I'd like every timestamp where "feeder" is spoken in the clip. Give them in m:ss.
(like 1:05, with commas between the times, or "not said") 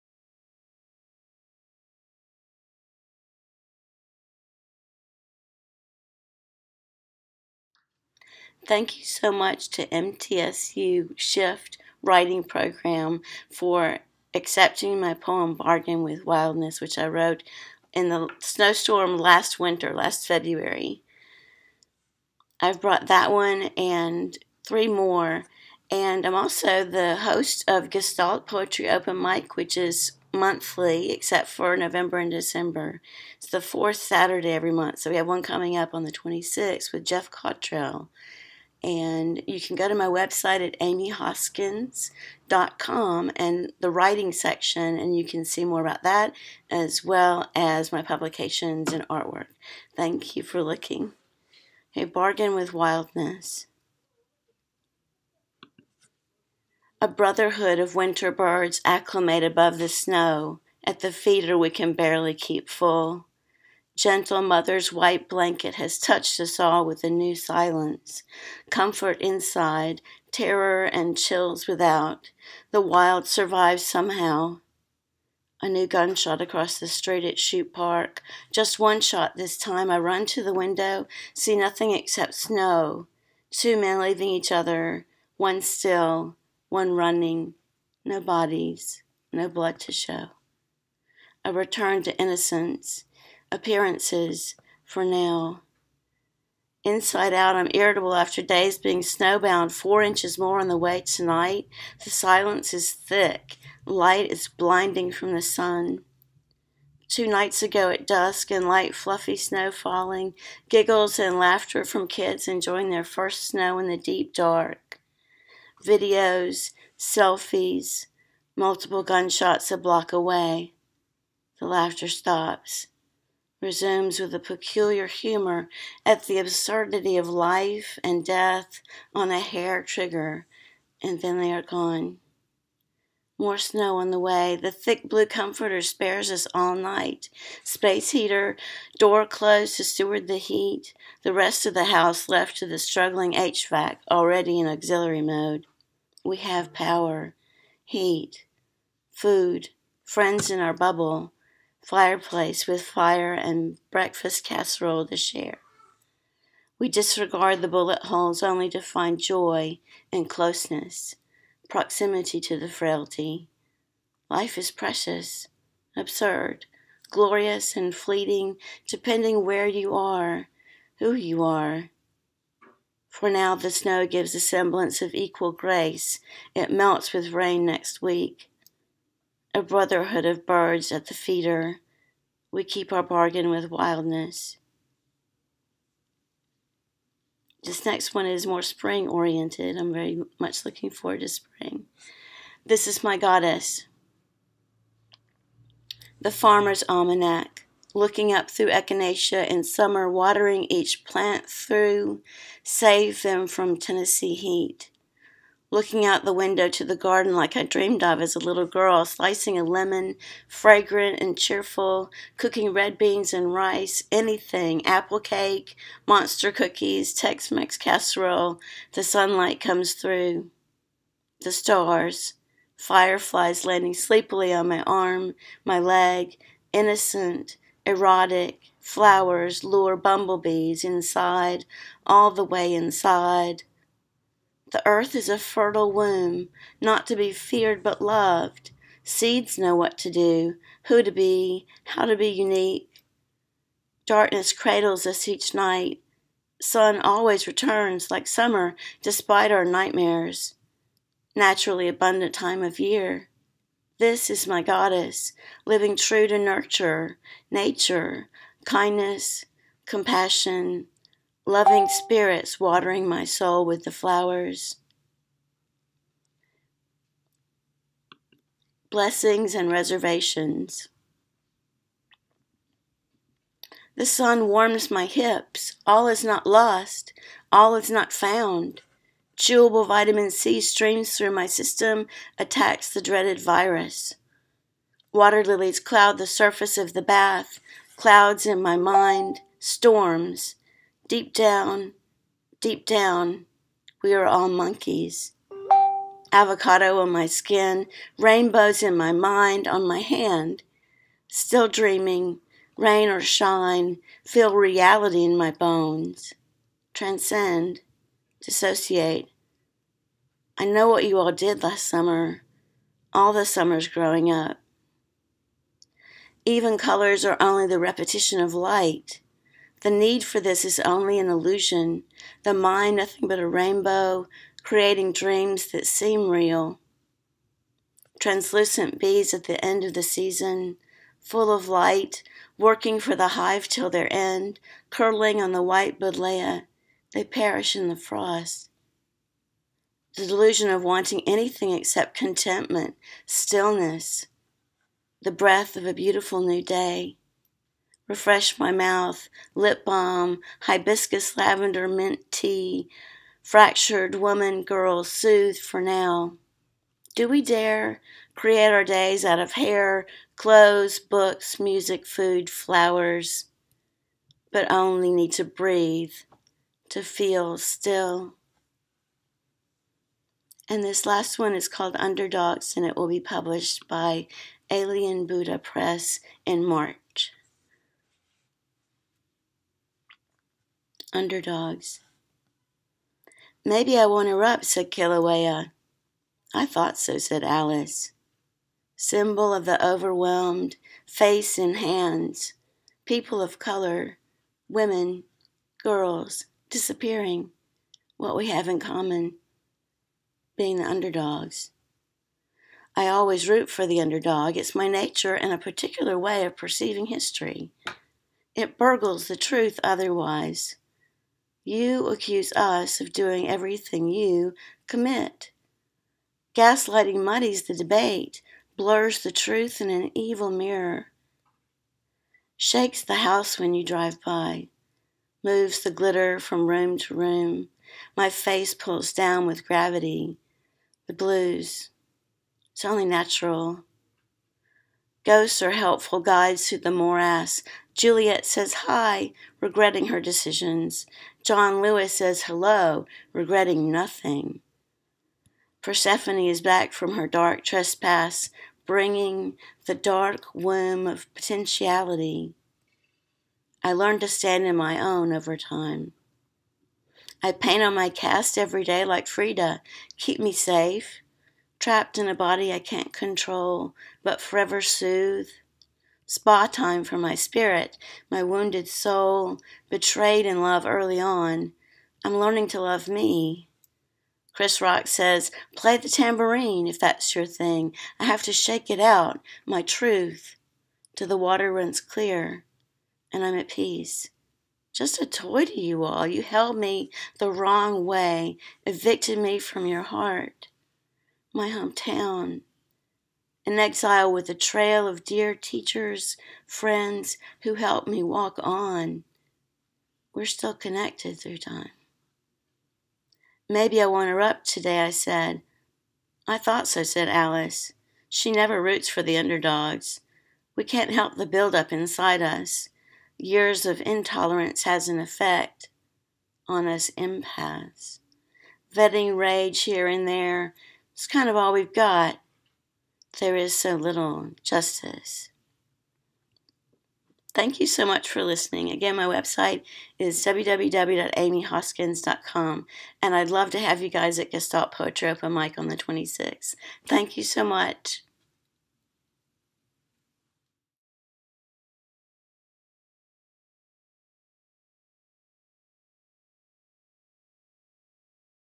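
1:01, 3:01.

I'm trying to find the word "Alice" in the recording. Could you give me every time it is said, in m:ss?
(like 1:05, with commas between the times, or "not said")
6:27, 8:27.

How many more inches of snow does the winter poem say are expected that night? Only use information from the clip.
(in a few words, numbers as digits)
4.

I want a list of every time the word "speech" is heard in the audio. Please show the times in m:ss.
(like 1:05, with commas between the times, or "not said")
not said.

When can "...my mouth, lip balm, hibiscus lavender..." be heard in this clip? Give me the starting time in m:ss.
5:48.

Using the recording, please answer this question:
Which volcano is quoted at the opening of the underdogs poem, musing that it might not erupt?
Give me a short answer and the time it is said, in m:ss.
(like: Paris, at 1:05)
Kilauea, at 6:24.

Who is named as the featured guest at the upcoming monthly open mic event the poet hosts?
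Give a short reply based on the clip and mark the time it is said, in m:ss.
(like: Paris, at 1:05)
Jeff Cottrell, at 0:37.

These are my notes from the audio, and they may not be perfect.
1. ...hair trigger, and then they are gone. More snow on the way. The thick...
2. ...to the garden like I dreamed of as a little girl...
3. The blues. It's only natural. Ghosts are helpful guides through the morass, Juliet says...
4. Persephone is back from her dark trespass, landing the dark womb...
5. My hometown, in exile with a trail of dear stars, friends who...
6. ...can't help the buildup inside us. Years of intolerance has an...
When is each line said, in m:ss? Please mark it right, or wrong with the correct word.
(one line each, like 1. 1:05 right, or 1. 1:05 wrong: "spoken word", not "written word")
1. 2:09 right
2. 3:26 right
3. 7:11 right
4. 7:25 wrong: "bringing", not "landing"
5. 8:11 wrong: "teachers", not "stars"
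6. 8:30 right.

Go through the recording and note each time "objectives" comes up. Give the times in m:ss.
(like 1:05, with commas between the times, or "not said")
not said.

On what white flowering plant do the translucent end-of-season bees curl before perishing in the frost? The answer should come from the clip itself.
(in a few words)
buddleia.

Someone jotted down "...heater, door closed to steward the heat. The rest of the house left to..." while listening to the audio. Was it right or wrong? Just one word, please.
right.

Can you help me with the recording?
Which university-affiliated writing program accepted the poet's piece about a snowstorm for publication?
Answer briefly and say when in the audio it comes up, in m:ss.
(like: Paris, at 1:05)
MTSU Shift Writing Program, at 0:09.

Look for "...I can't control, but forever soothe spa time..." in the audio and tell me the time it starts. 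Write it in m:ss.
7:42.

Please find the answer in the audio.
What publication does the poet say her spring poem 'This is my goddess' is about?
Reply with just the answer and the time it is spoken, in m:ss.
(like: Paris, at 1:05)
The Farmer's Almanac, at 3:16.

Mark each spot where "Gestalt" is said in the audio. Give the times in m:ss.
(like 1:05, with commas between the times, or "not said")
0:27, 8:54.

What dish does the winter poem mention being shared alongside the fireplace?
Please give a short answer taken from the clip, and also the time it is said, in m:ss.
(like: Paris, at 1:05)
breakfast casserole, at 2:33.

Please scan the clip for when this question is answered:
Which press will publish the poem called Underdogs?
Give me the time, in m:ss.
6:14.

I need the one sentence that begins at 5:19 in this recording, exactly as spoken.
The need for this is only an illusion, the mind nothing but a rainbow, creating dreams that seem real.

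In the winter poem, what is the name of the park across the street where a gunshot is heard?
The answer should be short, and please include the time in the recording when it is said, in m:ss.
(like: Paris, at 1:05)
Chute Park, at 1:17.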